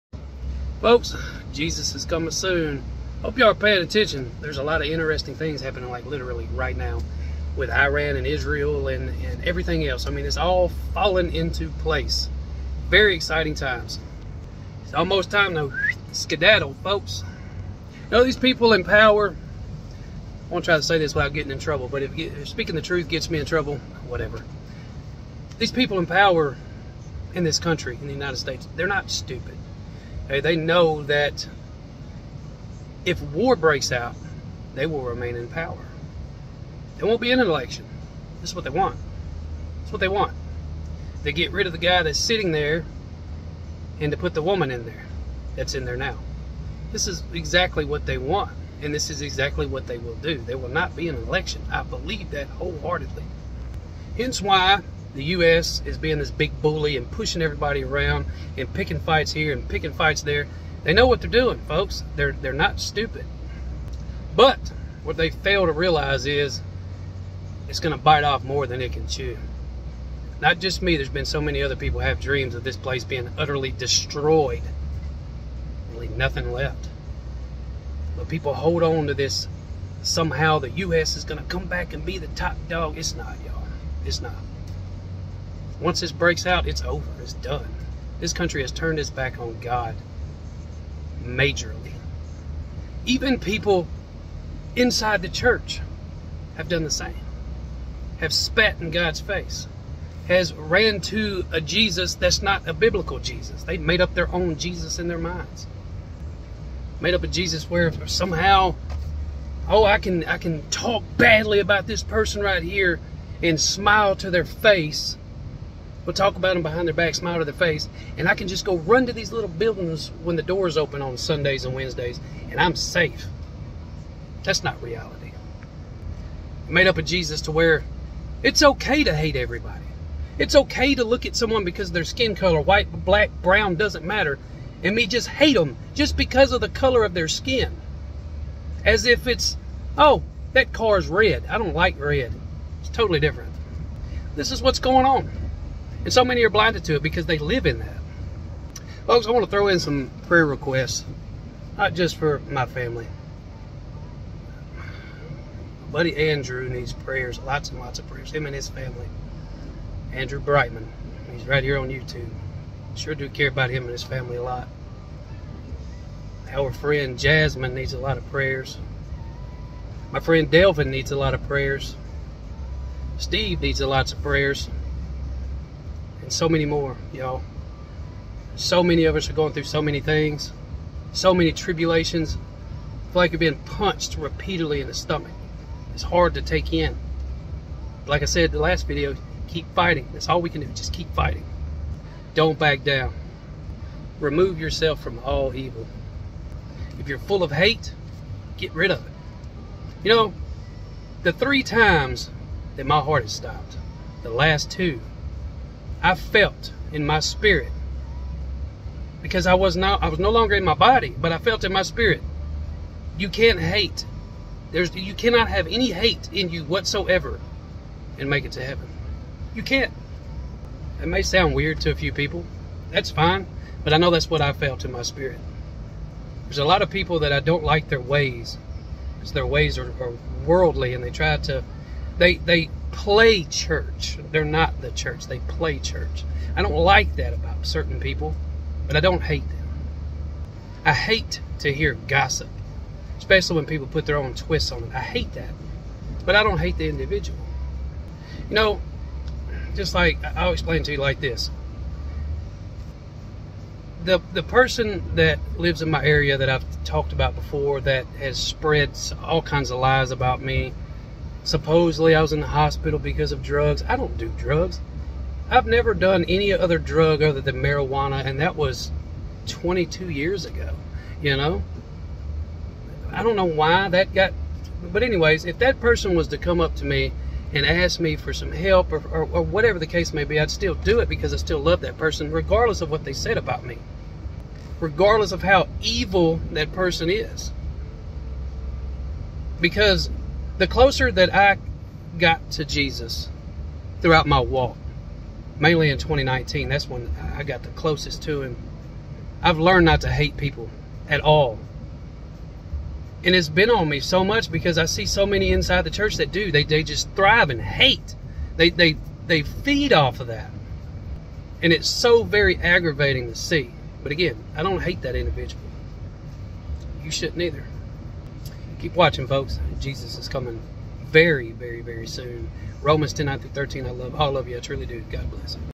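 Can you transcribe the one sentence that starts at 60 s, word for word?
They know what they're doing, folks.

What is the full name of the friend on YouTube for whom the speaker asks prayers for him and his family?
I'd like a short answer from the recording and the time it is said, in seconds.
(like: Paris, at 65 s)
Andrew Brightman, at 160 s.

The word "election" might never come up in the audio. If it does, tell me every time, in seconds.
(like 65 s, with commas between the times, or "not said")
37 s, 51 s.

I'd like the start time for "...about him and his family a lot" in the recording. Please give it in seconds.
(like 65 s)
163 s.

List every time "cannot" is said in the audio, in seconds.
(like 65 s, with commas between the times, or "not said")
215 s.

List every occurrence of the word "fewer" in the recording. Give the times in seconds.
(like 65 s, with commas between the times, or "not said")
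not said.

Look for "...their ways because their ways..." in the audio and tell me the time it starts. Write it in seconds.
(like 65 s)
227 s.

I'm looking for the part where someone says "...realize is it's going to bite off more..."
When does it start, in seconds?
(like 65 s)
65 s.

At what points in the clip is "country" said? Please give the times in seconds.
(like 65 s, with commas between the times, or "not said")
27 s, 88 s.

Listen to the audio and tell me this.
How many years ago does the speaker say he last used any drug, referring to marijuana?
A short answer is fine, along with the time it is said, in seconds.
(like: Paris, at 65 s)
22, at 269 s.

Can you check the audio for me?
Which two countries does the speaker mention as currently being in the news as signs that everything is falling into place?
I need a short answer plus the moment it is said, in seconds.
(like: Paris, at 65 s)
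Iran and Israel, at 7 s.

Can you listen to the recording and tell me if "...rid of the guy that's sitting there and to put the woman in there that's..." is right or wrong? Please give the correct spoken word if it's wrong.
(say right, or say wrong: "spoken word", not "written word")
right.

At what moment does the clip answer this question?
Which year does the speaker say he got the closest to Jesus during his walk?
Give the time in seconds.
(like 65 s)
295 s.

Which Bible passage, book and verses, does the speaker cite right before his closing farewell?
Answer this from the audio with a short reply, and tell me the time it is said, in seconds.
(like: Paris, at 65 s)
Romans 10:9-13, at 322 s.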